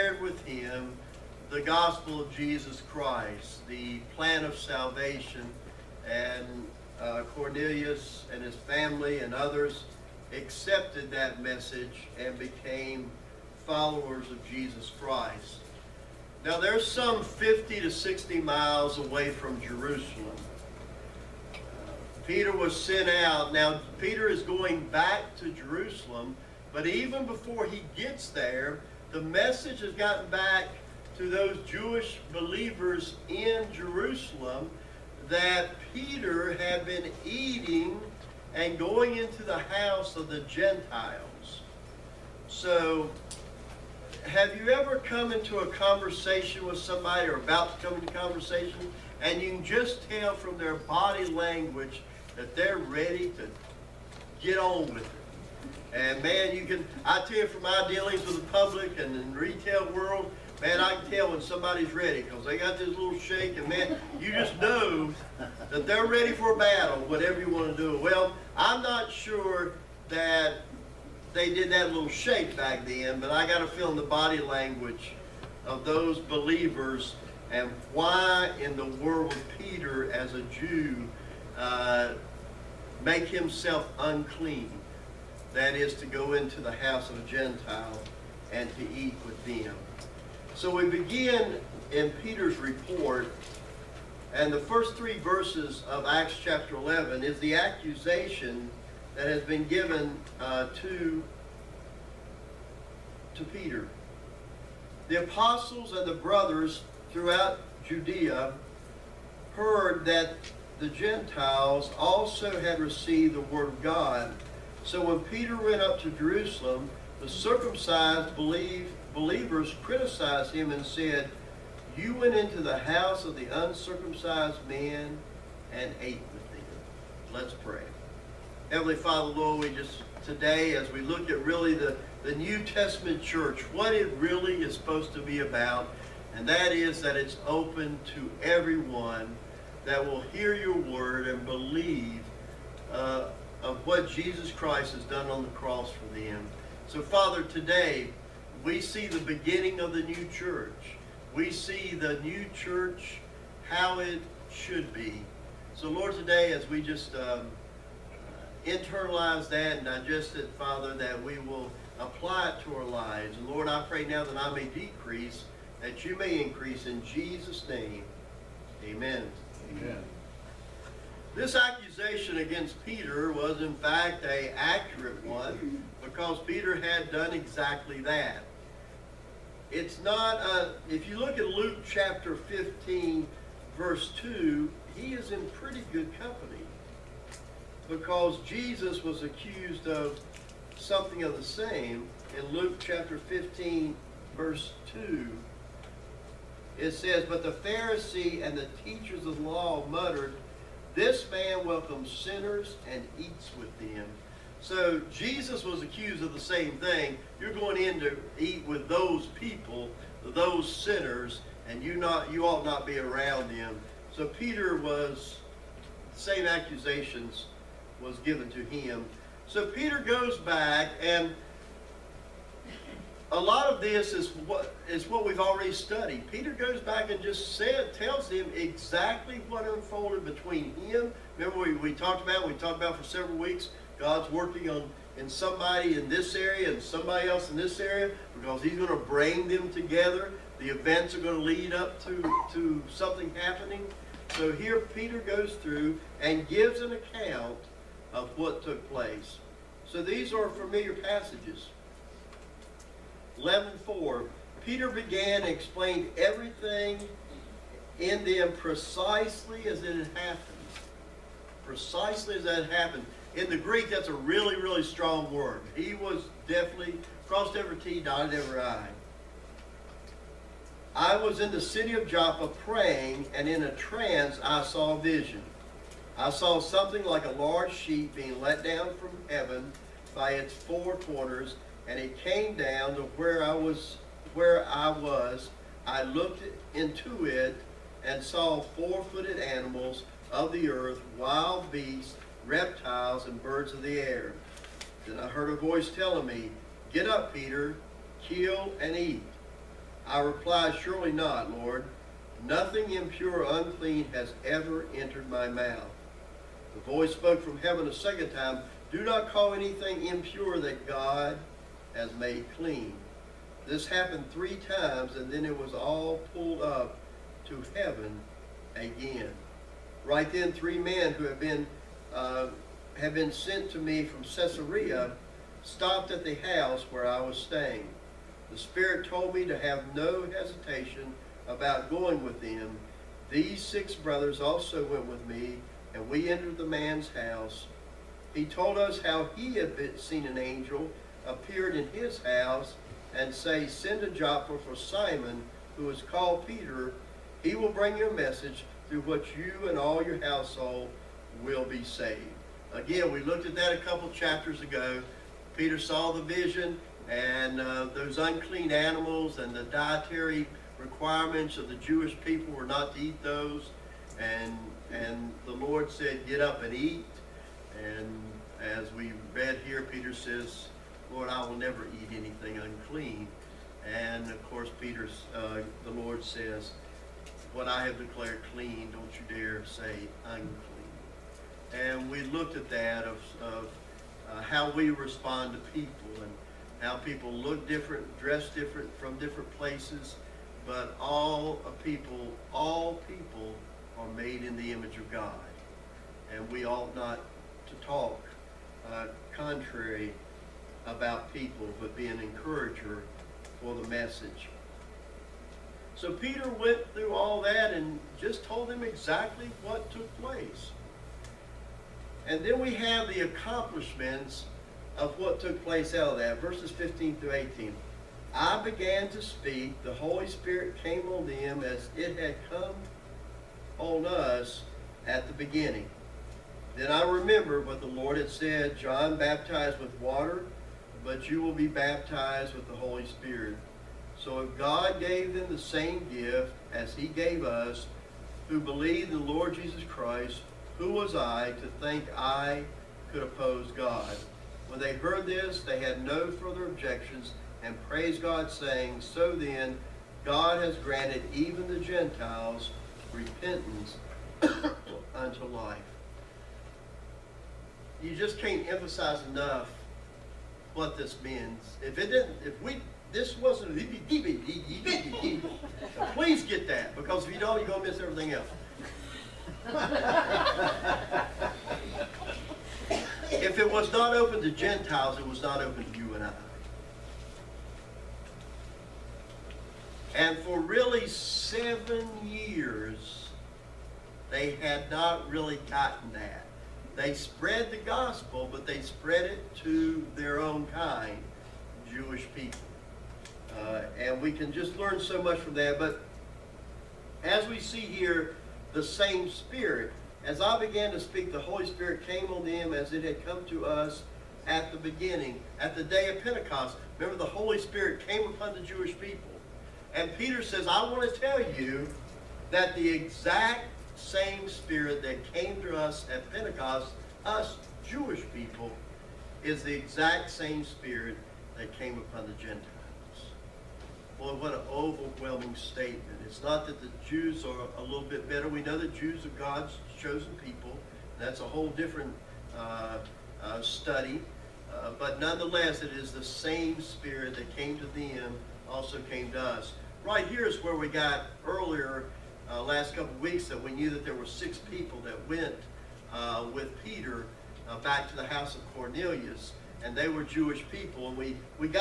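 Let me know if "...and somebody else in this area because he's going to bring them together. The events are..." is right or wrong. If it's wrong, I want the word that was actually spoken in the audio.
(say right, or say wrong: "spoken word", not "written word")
right.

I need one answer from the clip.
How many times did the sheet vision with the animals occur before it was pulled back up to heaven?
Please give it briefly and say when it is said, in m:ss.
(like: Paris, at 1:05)
3, at 5:14.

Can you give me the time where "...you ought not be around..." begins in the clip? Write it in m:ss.
3:32.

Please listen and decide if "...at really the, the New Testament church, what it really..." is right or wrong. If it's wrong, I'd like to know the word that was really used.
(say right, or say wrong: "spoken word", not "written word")
right.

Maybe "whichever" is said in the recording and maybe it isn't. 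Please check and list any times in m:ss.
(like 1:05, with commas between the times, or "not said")
not said.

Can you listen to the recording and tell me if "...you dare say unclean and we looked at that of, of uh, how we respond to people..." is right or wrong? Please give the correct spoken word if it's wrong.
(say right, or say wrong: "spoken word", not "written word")
right.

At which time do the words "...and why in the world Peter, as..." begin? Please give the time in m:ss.
1:17.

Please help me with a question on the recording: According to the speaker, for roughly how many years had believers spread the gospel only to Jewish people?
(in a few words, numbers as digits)
7.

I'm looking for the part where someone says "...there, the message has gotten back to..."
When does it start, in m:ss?
0:28.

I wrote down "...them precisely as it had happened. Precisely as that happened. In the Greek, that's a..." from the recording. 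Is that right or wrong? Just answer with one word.
right.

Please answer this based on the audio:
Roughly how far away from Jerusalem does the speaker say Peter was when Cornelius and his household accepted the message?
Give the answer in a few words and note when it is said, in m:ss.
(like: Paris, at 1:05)
50 to 60 miles, at 0:17.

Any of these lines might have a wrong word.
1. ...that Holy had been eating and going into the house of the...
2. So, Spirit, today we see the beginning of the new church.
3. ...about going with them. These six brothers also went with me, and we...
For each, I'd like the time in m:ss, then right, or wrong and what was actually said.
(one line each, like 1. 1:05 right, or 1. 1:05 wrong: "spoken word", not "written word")
1. 0:35 wrong: "Peter", not "Holy"
2. 2:26 wrong: "Father", not "Spirit"
3. 5:31 right.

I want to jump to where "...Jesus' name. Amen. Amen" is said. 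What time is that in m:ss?
2:47.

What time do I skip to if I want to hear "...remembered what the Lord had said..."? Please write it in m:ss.
7:07.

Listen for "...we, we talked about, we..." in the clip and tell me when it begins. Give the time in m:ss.
3:51.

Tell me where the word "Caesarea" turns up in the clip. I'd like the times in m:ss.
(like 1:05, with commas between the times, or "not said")
5:24.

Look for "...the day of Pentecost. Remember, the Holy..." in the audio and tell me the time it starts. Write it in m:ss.
8:25.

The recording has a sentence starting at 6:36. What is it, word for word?
And we ought not to talk uh, contrary about people, but be an encourager for the message.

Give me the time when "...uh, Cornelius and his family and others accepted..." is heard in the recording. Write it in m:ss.
0:06.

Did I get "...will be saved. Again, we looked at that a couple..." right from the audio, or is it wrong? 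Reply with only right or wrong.
right.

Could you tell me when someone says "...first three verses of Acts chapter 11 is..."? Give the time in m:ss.
1:34.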